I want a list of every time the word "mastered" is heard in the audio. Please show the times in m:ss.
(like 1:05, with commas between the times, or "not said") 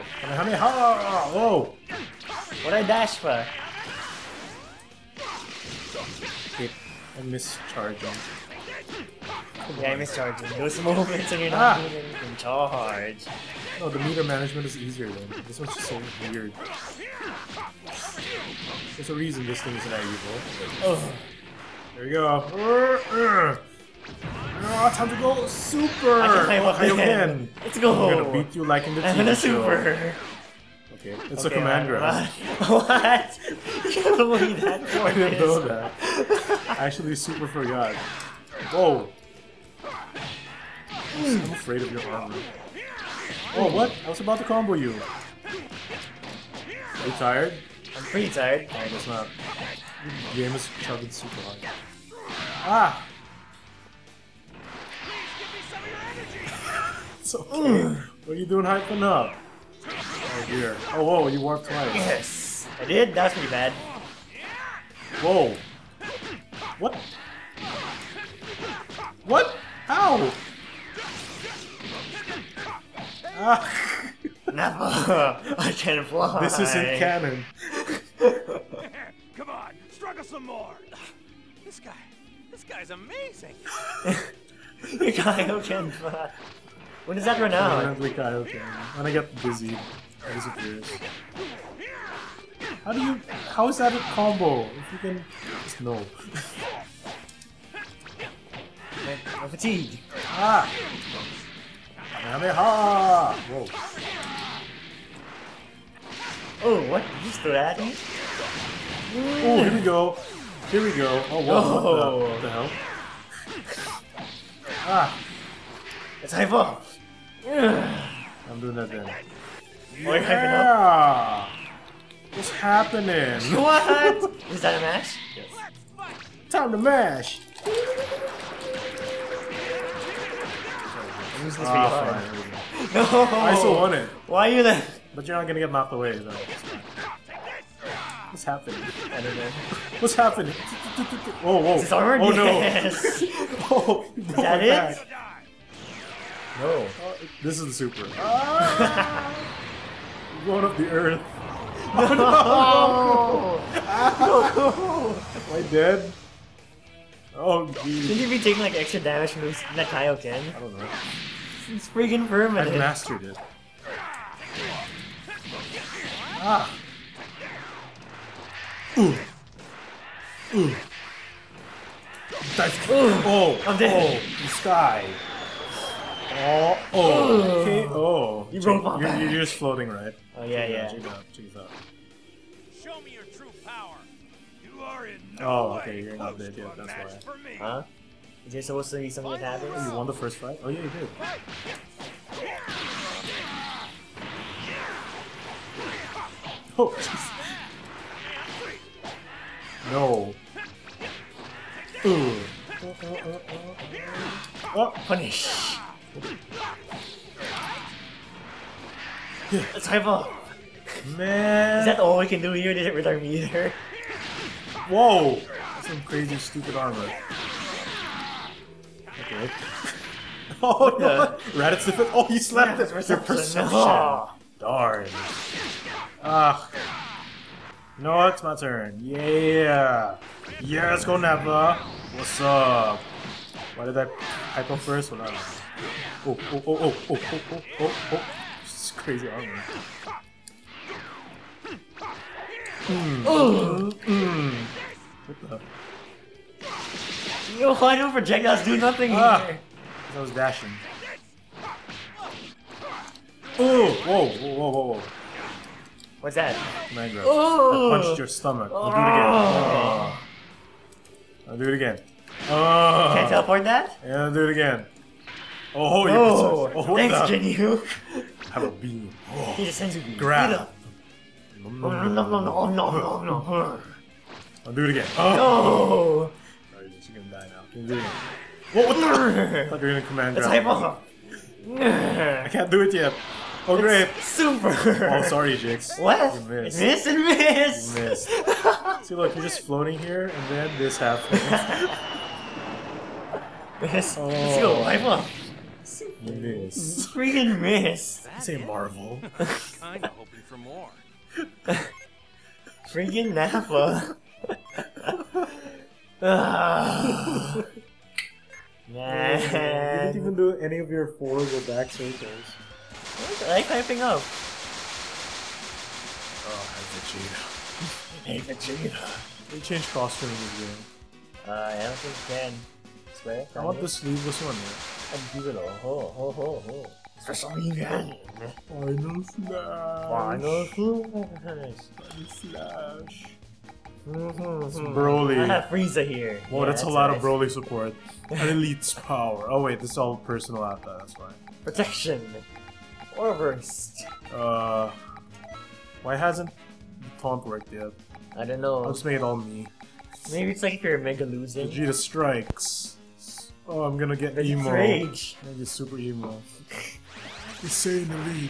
2:42.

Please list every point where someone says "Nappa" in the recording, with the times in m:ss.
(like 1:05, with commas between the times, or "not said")
3:51, 5:03.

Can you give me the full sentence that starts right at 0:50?
The game is chugging super hard.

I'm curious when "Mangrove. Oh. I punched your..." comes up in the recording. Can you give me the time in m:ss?
4:16.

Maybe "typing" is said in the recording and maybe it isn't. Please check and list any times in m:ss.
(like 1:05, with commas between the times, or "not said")
5:13.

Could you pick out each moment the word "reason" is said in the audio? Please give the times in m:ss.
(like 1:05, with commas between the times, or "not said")
0:19, 5:27.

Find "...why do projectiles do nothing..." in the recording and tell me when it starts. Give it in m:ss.
4:07.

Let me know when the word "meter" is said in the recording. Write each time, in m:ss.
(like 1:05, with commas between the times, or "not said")
0:14, 3:33.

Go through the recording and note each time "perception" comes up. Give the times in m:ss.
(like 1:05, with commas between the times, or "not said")
3:43.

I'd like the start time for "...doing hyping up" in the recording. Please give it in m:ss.
0:58.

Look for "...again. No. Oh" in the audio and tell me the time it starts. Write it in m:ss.
4:34.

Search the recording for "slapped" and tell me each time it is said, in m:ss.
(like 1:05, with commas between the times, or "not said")
3:42.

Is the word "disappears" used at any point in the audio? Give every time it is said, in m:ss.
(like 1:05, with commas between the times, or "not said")
1:30.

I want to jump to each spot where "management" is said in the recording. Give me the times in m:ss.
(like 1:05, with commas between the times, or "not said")
0:14.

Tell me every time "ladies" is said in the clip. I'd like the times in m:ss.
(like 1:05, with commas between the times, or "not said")
not said.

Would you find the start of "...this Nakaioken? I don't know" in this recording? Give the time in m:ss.
2:39.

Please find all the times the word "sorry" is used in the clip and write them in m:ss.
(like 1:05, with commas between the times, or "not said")
4:45.